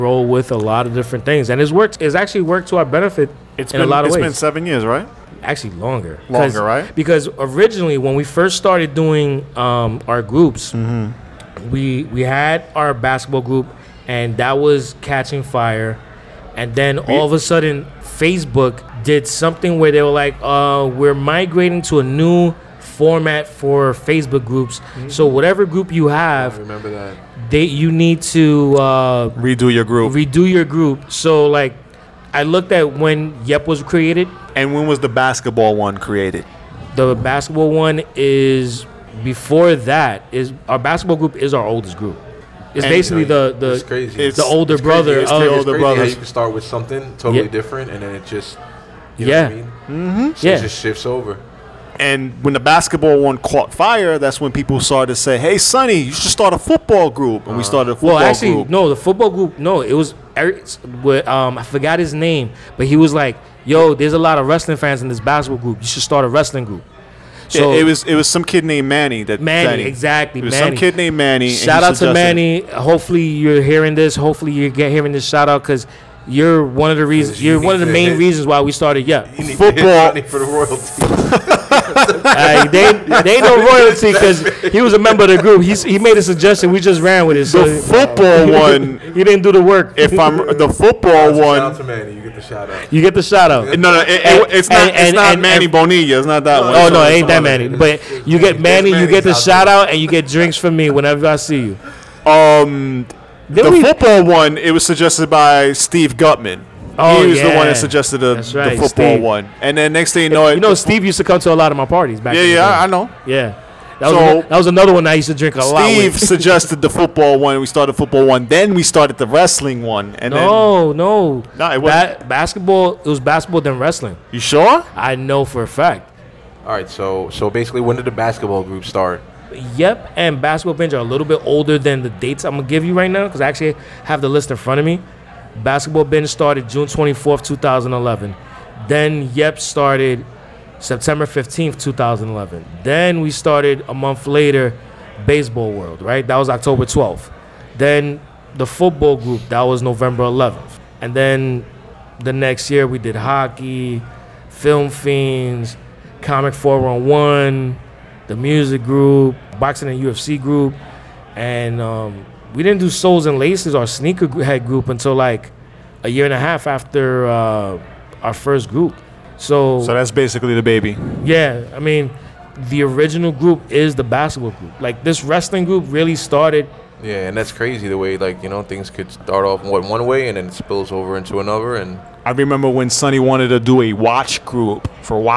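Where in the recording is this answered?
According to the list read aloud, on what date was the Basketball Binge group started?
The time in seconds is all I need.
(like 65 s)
136 s.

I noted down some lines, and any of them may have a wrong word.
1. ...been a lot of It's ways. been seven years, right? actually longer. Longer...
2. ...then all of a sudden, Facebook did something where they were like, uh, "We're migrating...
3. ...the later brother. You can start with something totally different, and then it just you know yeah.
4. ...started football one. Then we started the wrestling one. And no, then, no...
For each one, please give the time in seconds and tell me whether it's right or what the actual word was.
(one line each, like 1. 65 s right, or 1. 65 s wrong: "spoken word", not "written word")
1. 3 s right
2. 16 s right
3. 45 s wrong: "older", not "later"
4. 117 s right.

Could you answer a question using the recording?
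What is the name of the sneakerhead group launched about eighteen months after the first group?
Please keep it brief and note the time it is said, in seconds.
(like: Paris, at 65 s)
Souls and Laces, at 162 s.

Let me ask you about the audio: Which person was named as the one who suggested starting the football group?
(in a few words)
Steve Gutman.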